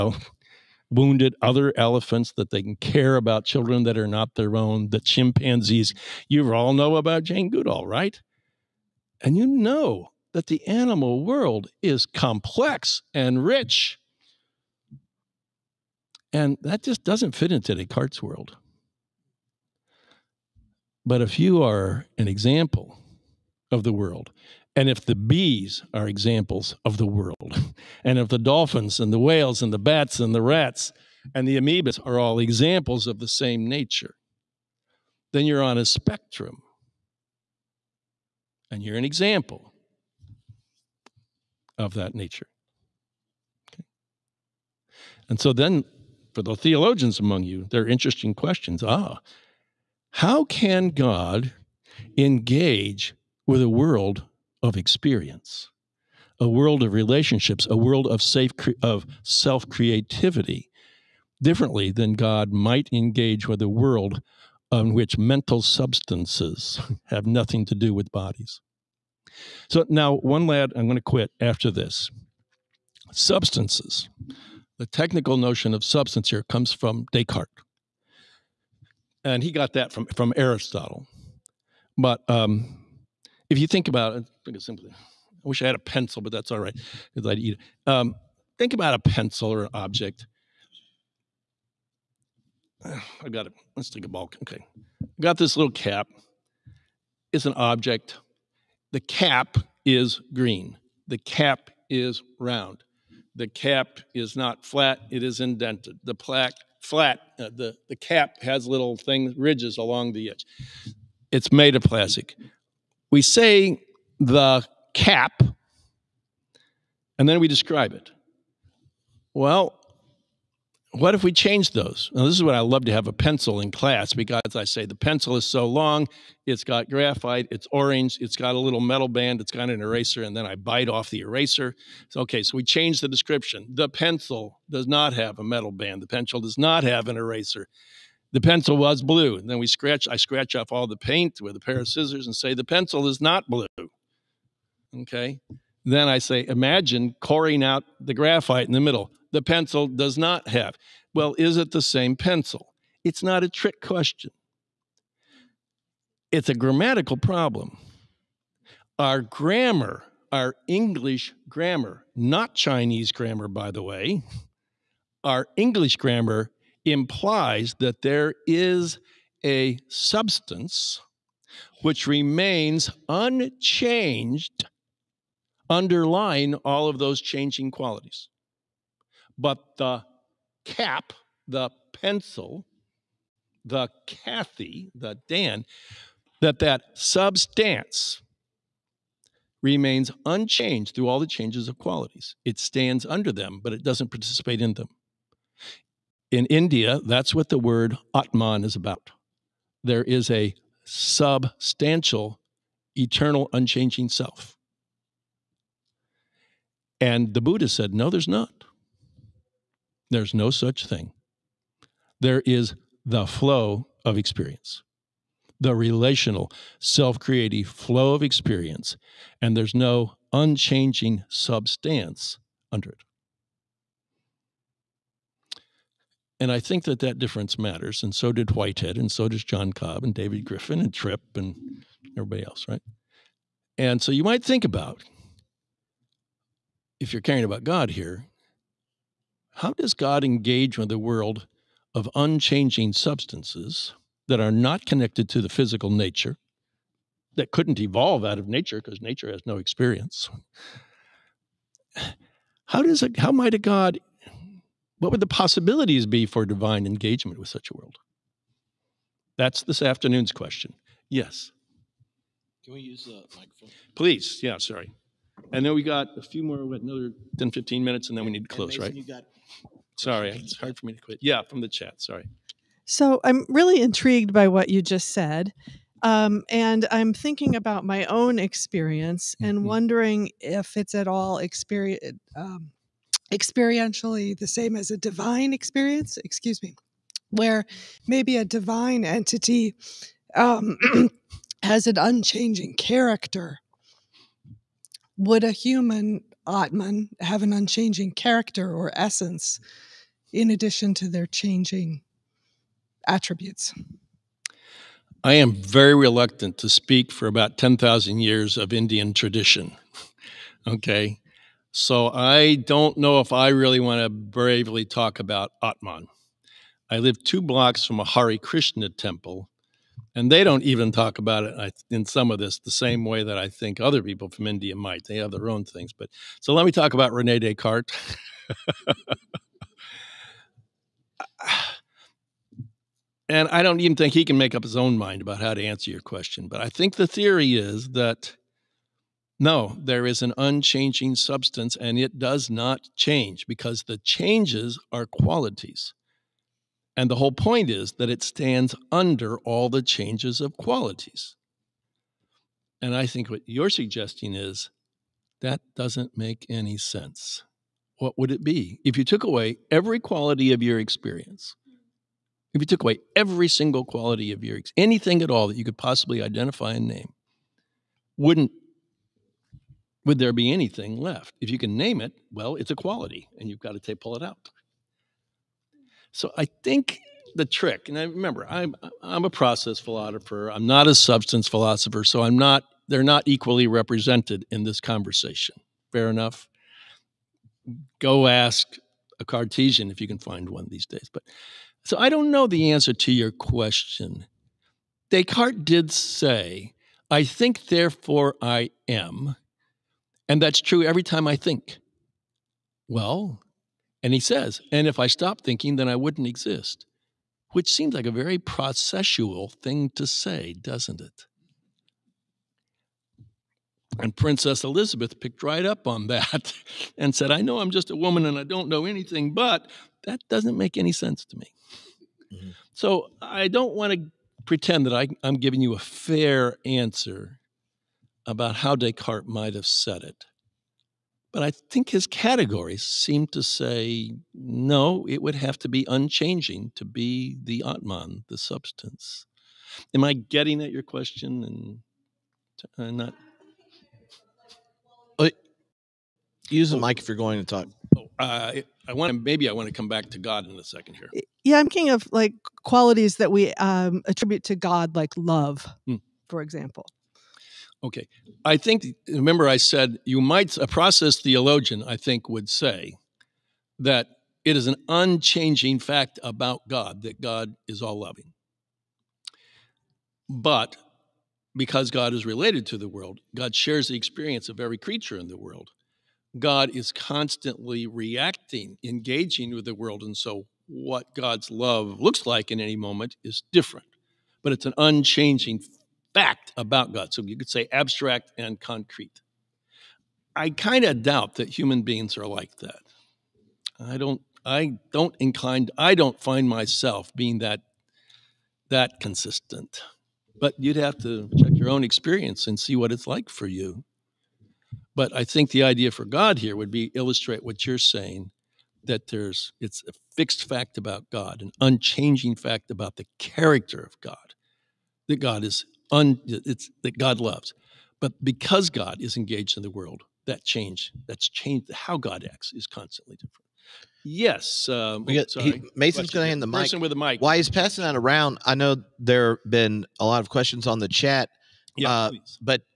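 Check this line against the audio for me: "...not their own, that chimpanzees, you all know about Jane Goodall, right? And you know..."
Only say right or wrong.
right.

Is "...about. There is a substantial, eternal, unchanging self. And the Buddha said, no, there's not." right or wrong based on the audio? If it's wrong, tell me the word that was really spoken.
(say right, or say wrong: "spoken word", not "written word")
right.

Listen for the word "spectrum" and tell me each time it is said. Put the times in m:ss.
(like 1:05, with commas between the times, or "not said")
0:35.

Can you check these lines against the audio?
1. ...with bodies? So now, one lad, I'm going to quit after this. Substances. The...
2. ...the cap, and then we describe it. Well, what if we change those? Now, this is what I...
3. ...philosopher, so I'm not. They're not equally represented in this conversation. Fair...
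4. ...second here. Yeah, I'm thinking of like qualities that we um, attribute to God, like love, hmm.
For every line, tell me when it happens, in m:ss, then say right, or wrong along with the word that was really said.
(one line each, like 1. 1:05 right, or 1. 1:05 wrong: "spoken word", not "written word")
1. 1:07 right
2. 1:54 right
3. 6:21 right
4. 7:30 right.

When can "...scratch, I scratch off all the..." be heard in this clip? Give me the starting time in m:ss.
2:19.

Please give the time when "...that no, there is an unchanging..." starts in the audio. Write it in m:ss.
5:37.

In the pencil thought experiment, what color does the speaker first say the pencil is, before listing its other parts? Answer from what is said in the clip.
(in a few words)
orange.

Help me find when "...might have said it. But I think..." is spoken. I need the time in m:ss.
7:09.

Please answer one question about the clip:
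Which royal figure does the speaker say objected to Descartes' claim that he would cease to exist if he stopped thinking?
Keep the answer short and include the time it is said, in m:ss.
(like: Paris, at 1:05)
Princess Elizabeth, at 6:54.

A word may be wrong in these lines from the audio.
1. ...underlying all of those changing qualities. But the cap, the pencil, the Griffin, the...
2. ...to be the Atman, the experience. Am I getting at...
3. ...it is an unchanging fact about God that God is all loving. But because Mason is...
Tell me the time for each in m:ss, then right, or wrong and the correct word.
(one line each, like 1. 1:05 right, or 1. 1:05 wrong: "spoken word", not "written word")
1. 2:55 wrong: "Kathy", not "Griffin"
2. 7:16 wrong: "substance", not "experience"
3. 7:44 wrong: "God", not "Mason".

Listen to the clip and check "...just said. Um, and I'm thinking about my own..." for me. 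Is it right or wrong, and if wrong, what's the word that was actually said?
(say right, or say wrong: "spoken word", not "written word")
right.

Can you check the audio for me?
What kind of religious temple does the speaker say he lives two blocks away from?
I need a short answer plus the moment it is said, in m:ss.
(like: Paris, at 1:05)
Hare Krishna temple, at 5:18.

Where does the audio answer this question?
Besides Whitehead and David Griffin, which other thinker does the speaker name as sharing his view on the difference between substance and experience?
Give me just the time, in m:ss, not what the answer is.
3:49.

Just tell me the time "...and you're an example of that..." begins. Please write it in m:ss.
0:38.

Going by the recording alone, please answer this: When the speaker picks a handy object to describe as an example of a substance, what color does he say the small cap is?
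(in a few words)
green.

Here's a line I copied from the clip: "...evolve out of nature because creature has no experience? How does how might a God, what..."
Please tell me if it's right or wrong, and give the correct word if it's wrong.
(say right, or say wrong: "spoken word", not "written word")
wrong: "nature", not "creature".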